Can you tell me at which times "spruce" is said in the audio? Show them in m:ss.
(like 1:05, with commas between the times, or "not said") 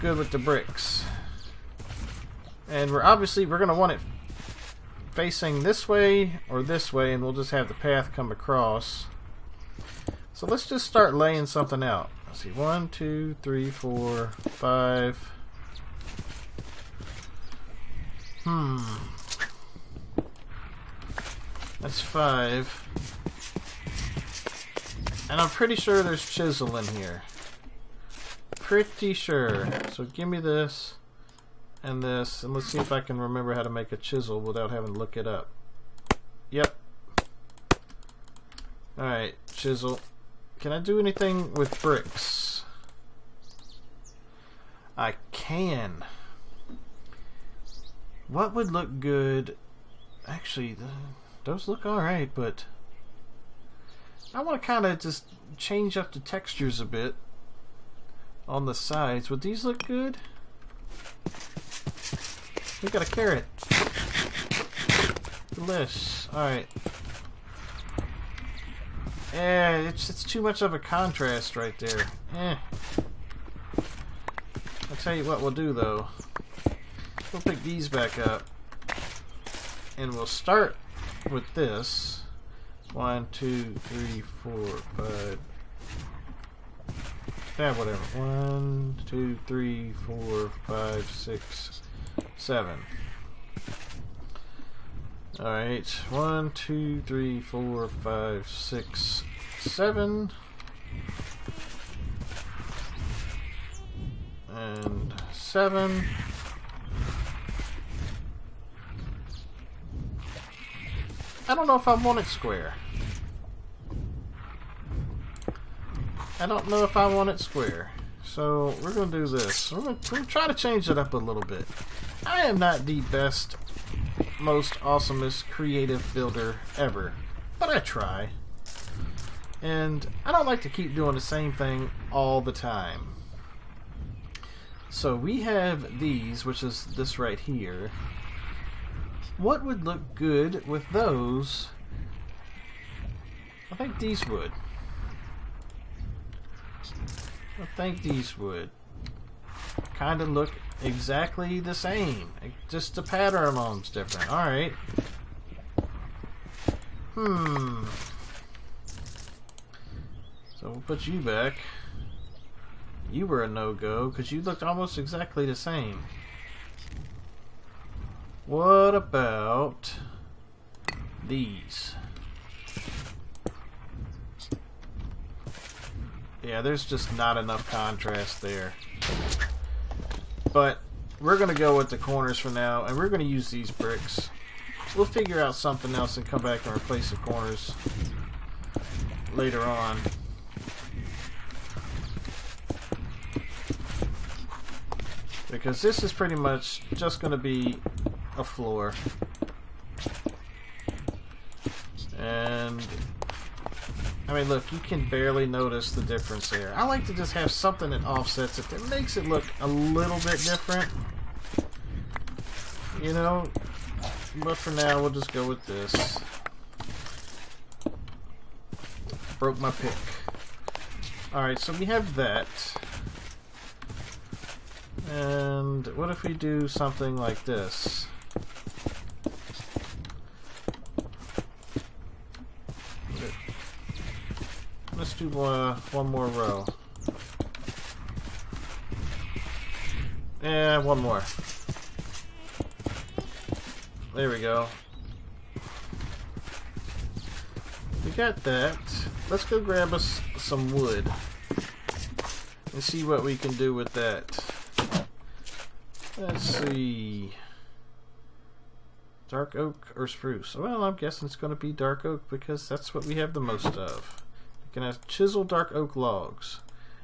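4:20.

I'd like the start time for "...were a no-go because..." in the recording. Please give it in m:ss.
2:43.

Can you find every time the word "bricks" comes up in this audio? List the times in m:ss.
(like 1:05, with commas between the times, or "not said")
0:00, 0:41, 3:03.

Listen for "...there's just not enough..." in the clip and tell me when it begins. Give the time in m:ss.
2:56.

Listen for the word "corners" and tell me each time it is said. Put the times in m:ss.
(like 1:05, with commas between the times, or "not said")
3:01, 3:07.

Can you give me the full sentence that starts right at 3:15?
Because this is pretty much just going to be a floor.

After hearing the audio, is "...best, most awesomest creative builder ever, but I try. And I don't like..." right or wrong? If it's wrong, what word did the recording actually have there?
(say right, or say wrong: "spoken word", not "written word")
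right.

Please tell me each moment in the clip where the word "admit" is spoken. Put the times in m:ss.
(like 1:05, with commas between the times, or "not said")
not said.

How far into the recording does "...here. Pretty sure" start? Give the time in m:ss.
0:26.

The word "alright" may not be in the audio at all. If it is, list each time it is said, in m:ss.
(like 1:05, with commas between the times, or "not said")
0:38, 0:51, 1:06, 1:35, 3:41.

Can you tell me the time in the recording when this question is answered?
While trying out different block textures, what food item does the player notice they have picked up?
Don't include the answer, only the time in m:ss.
1:03.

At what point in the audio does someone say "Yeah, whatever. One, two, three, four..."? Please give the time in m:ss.
1:27.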